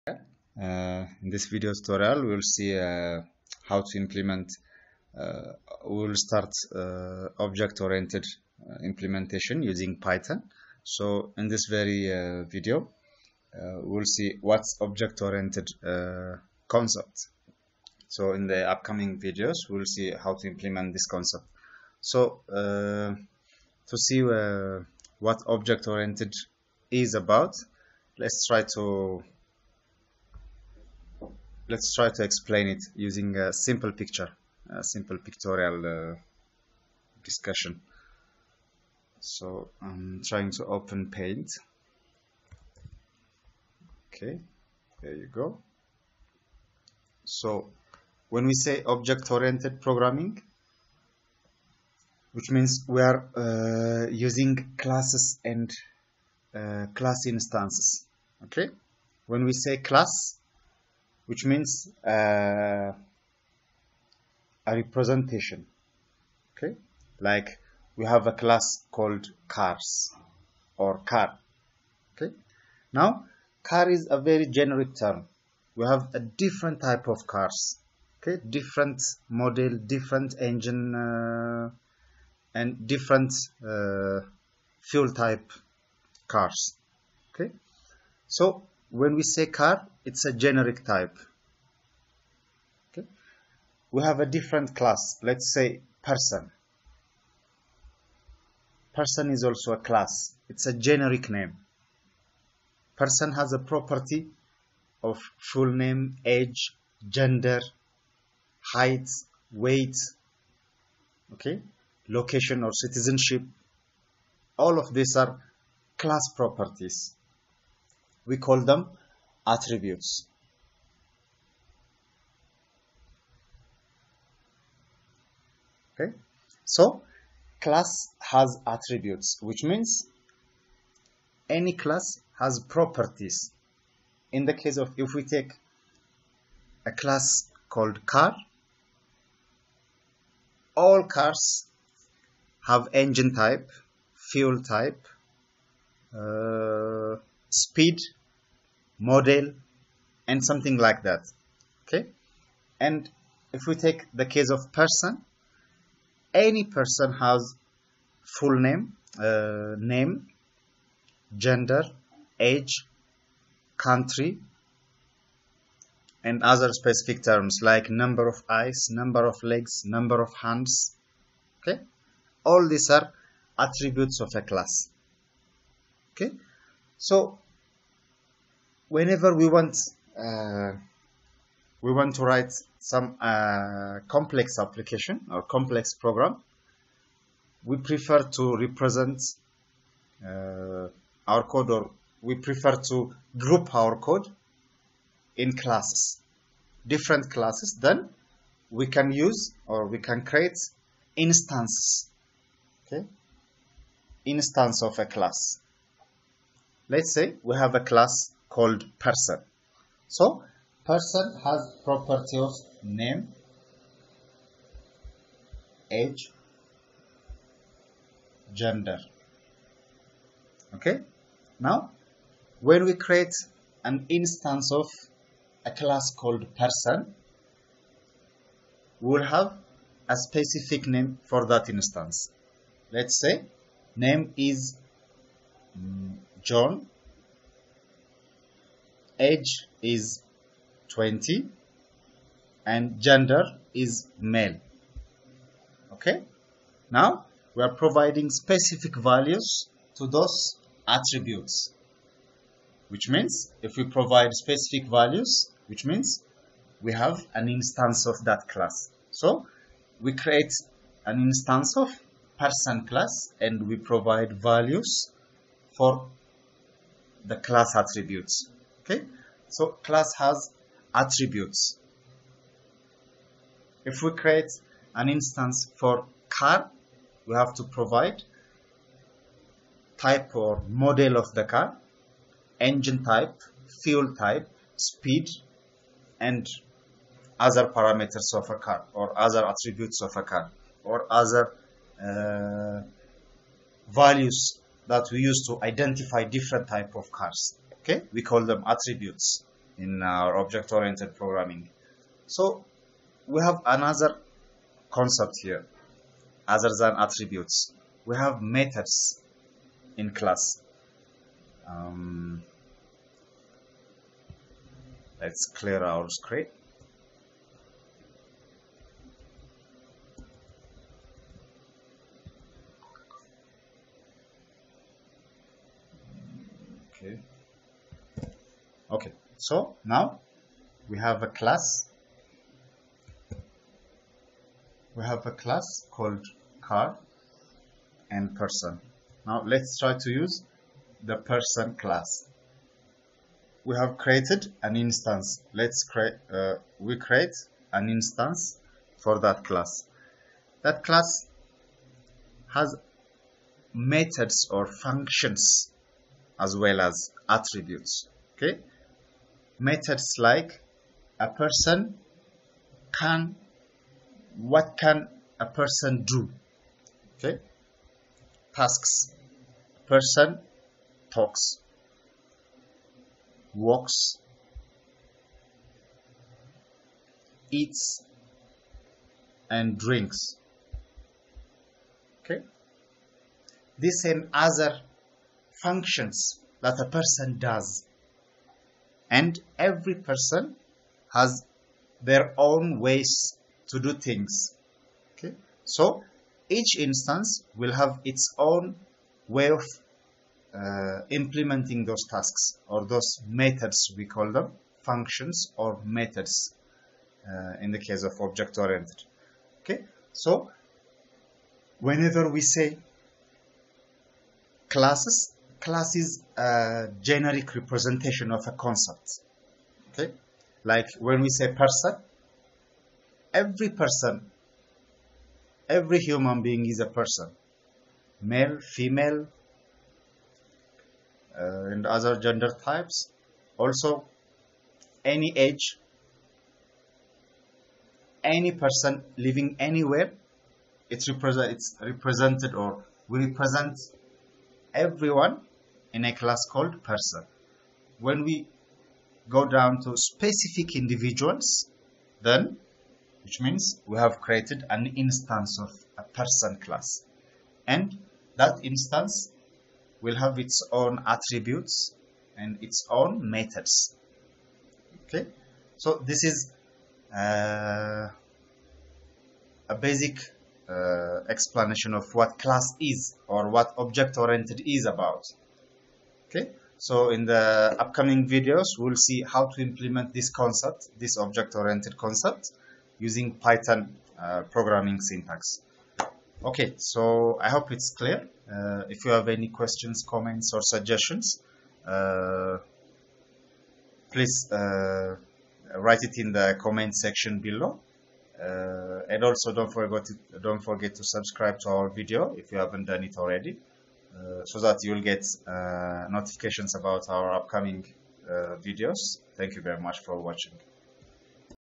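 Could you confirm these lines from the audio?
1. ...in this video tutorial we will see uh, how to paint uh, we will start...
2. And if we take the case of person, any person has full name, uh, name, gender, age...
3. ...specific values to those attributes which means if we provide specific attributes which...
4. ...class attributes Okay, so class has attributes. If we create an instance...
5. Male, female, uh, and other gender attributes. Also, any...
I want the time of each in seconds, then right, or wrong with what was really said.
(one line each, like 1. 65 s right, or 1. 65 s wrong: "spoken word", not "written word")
1. 1 s wrong: "implement", not "paint"
2. 152 s right
3. 248 s wrong: "values", not "attributes"
4. 267 s right
5. 428 s wrong: "types", not "attributes".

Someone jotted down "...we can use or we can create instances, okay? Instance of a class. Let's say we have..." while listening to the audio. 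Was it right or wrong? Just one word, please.
right.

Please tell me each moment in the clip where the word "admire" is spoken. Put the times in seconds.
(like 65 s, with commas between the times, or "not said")
not said.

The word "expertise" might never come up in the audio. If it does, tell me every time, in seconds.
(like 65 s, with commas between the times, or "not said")
not said.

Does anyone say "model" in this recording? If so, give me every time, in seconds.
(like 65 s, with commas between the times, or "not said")
79 s, 149 s, 280 s.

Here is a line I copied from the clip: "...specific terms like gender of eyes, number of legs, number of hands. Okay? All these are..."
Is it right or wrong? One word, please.
wrong.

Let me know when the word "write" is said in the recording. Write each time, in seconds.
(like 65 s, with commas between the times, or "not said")
182 s, 495 s.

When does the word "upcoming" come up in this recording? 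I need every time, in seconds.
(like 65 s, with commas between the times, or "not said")
18 s, 477 s, 507 s.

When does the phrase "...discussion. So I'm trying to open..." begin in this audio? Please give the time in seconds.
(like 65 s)
37 s.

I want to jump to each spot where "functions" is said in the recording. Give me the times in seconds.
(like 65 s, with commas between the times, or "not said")
354 s, 385 s, 404 s.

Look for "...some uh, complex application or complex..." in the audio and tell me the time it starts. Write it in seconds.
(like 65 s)
182 s.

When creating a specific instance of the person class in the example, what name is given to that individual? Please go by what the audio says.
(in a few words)
John.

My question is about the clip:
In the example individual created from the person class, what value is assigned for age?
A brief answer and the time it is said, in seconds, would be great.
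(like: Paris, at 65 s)
20, at 240 s.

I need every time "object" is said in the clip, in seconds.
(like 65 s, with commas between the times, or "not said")
7 s, 14 s, 25 s, 48 s, 300 s, 408 s, 473 s, 481 s.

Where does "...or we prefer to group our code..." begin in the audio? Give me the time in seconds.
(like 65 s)
191 s.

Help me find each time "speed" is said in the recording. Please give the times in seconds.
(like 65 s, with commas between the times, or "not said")
147 s, 284 s.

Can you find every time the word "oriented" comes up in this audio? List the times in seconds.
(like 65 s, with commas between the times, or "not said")
7 s, 14 s, 25 s, 48 s, 300 s, 408 s, 474 s, 481 s.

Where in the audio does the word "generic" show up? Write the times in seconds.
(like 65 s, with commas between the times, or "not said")
74 s, 90 s, 100 s, 417 s.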